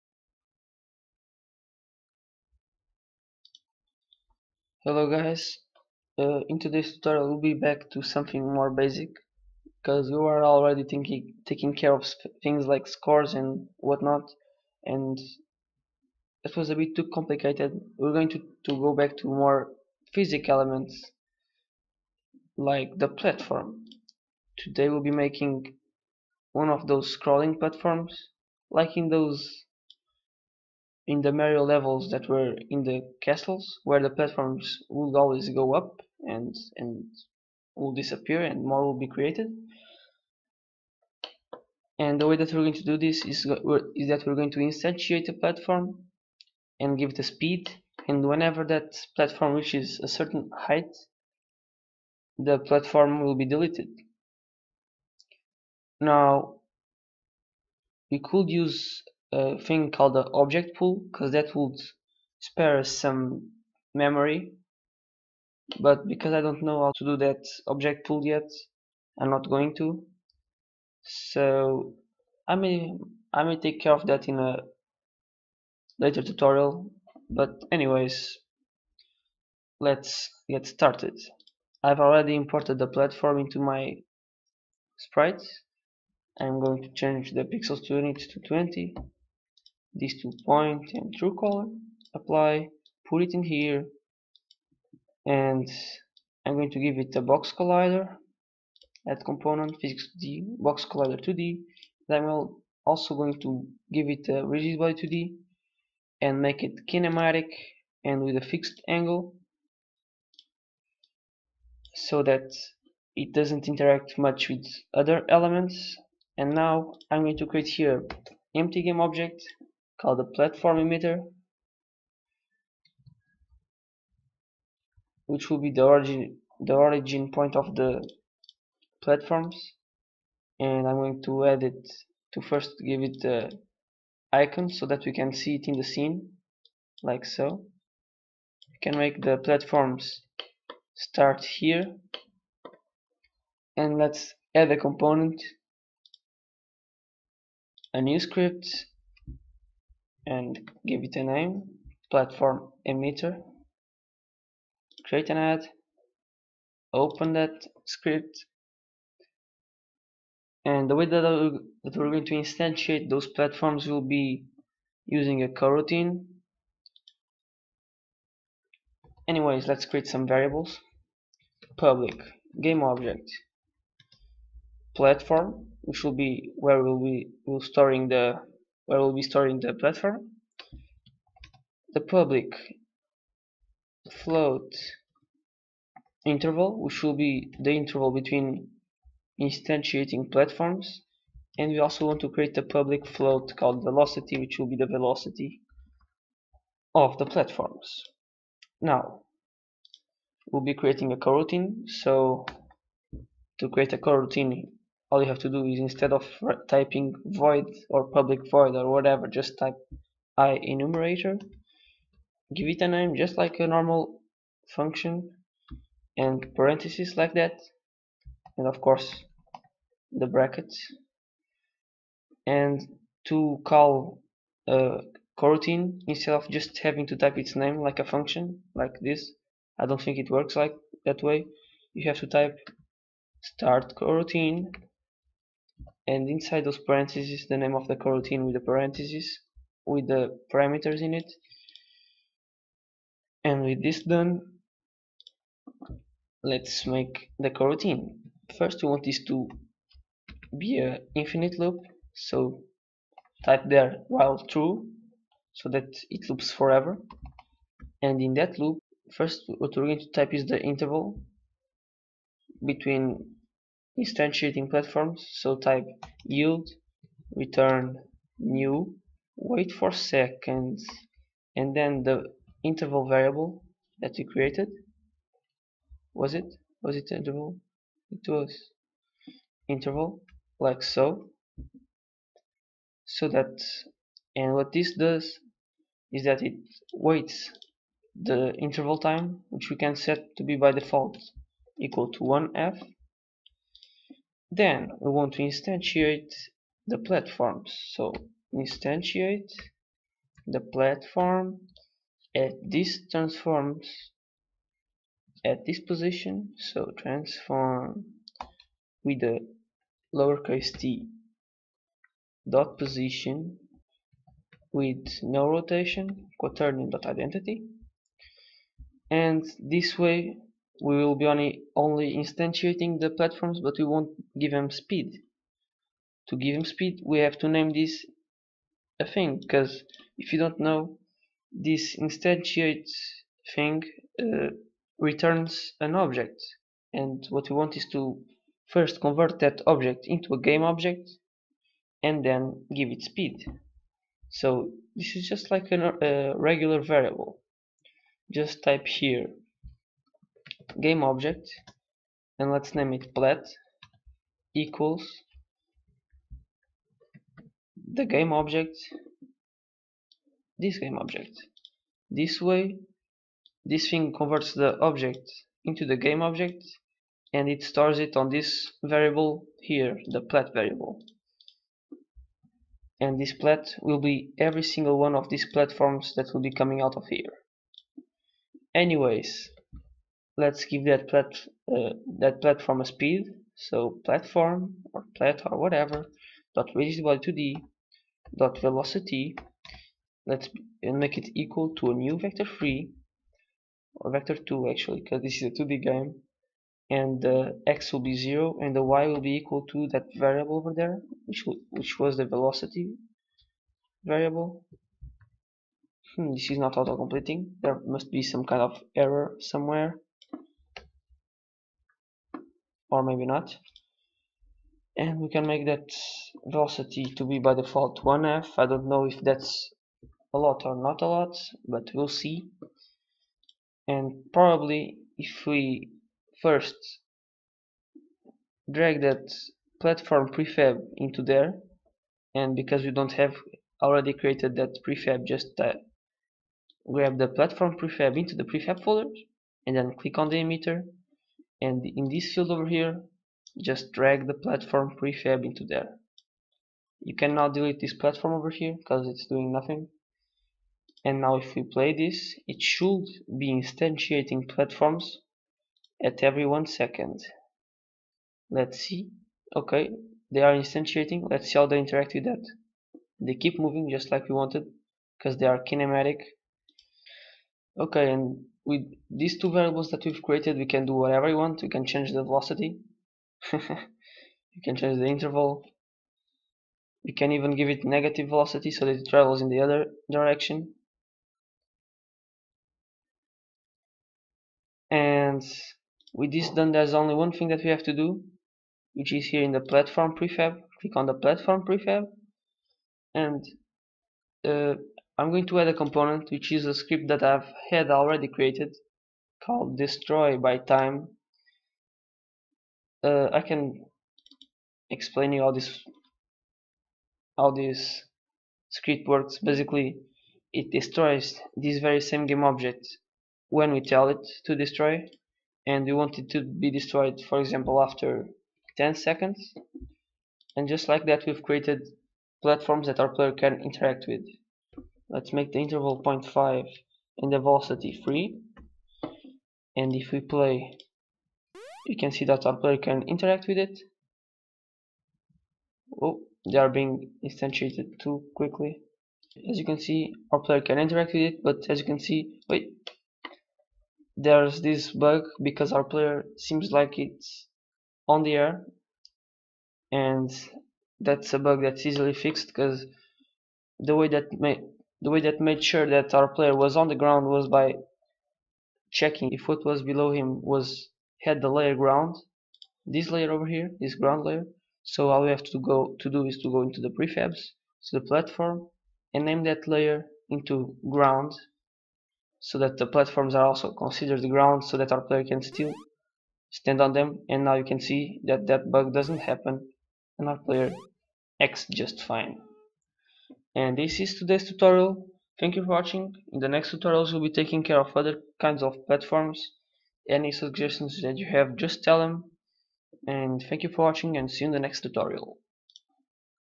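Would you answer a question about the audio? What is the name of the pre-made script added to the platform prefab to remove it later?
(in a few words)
destroy by time.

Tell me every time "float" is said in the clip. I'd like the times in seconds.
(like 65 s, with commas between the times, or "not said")
184 s, 193 s.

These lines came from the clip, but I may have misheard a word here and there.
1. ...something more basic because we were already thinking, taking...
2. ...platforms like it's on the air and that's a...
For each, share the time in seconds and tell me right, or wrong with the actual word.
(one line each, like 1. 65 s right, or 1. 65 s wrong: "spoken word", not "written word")
1. 8 s right
2. 546 s wrong: "seems", not "platforms".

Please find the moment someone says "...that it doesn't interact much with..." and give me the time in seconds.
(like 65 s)
112 s.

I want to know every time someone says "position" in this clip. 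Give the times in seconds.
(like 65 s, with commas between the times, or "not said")
305 s, 312 s.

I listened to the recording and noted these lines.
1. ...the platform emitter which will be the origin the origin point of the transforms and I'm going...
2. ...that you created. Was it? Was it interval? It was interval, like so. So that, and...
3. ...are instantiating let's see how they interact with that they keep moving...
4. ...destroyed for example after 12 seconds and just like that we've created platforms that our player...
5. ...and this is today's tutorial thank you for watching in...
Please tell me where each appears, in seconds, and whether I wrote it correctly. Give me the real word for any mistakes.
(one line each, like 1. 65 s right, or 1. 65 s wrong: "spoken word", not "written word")
1. 120 s wrong: "platforms", not "transforms"
2. 273 s right
3. 460 s right
4. 516 s wrong: "10", not "12"
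5. 583 s right.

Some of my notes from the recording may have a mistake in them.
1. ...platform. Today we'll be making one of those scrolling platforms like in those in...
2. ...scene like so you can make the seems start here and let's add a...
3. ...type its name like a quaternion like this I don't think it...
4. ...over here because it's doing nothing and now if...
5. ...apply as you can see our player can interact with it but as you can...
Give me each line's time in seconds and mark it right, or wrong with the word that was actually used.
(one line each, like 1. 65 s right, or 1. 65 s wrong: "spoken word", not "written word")
1. 23 s right
2. 135 s wrong: "platforms", not "seems"
3. 227 s wrong: "function", not "quaternion"
4. 448 s right
5. 538 s wrong: "quickly", not "apply".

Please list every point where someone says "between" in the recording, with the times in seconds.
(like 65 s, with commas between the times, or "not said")
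188 s, 262 s.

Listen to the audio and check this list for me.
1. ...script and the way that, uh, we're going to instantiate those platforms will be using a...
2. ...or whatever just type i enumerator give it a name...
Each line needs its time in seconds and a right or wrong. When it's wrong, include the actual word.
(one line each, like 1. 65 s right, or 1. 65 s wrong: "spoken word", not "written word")
1. 157 s right
2. 208 s right.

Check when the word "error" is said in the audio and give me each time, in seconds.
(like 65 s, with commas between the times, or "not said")
409 s.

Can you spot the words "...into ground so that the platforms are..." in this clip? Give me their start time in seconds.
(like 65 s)
570 s.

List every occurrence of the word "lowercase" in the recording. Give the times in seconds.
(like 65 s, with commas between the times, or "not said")
310 s.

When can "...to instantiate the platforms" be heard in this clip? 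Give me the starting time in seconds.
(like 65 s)
295 s.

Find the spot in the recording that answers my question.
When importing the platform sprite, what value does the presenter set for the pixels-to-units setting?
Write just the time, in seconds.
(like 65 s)
88 s.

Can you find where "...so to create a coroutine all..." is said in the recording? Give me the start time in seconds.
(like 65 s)
201 s.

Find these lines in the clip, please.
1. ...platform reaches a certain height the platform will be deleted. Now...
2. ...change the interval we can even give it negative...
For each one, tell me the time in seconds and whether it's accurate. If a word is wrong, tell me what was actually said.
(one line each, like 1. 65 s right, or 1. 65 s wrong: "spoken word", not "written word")
1. 49 s right
2. 474 s right.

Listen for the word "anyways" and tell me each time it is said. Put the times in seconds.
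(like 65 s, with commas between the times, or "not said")
77 s, 169 s, 378 s.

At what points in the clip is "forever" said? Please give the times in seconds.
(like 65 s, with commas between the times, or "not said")
256 s.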